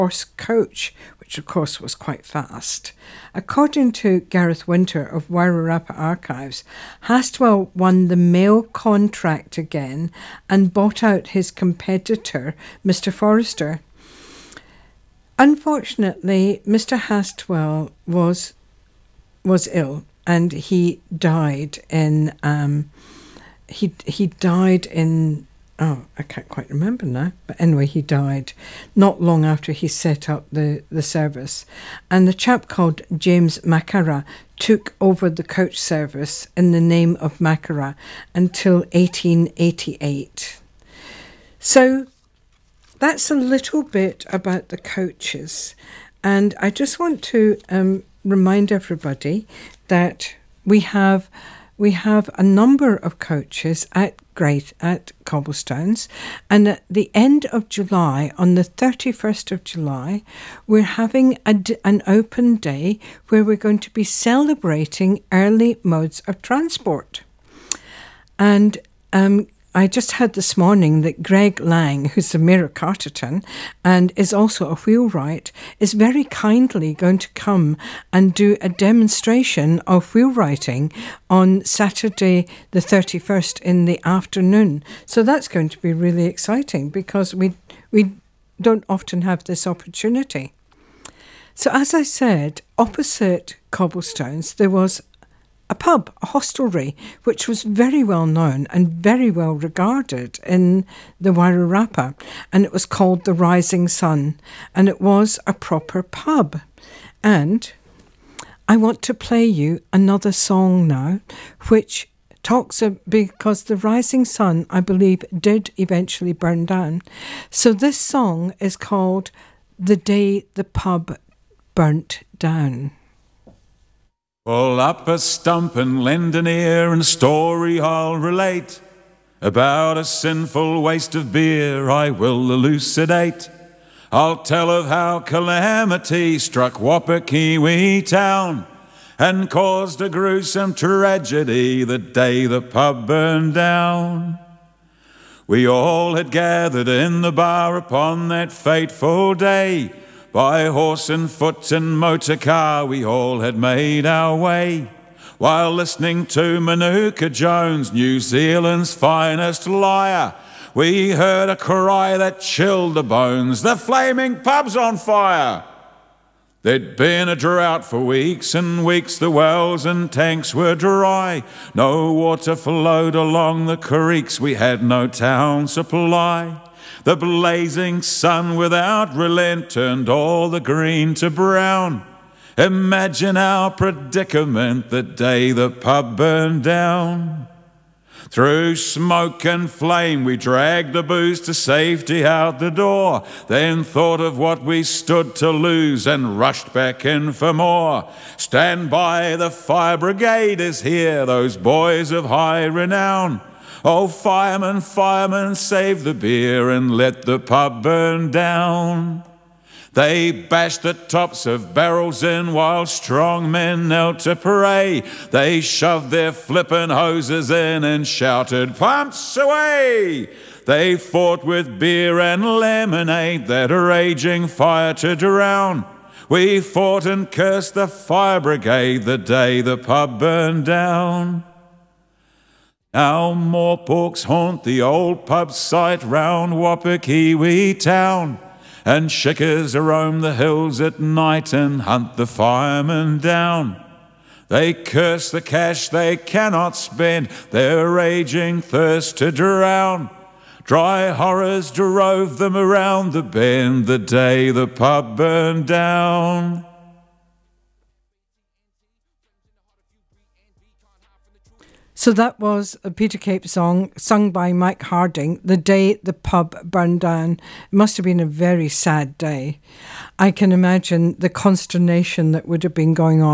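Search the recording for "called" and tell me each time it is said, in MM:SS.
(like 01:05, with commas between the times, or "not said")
00:32, 01:42, 01:58.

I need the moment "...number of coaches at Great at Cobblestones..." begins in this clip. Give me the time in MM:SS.
00:52.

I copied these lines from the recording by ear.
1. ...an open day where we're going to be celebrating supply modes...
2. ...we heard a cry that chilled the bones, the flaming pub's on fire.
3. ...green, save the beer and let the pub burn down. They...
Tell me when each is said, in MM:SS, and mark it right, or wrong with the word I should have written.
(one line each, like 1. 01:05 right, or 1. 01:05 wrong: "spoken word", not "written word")
1. 01:01 wrong: "early", not "supply"
2. 02:40 right
3. 03:24 wrong: "firemen", not "green".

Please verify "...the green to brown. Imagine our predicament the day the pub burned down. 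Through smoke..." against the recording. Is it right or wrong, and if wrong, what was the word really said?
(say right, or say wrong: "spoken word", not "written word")
right.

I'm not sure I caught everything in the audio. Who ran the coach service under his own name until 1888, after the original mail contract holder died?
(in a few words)
James Macara.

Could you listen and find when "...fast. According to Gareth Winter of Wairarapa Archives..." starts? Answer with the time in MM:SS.
00:02.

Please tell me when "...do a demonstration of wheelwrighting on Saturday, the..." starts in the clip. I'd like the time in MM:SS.
01:18.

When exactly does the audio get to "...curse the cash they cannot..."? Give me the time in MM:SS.
04:04.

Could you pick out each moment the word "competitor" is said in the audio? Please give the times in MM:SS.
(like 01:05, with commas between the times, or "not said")
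00:11.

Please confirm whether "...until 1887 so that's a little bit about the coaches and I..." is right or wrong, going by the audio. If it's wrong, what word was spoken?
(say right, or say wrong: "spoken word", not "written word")
wrong: "1888", not "1887".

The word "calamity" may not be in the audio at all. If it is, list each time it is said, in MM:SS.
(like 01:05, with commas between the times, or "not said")
02:15.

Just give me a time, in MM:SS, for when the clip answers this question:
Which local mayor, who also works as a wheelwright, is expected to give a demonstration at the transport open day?
01:11.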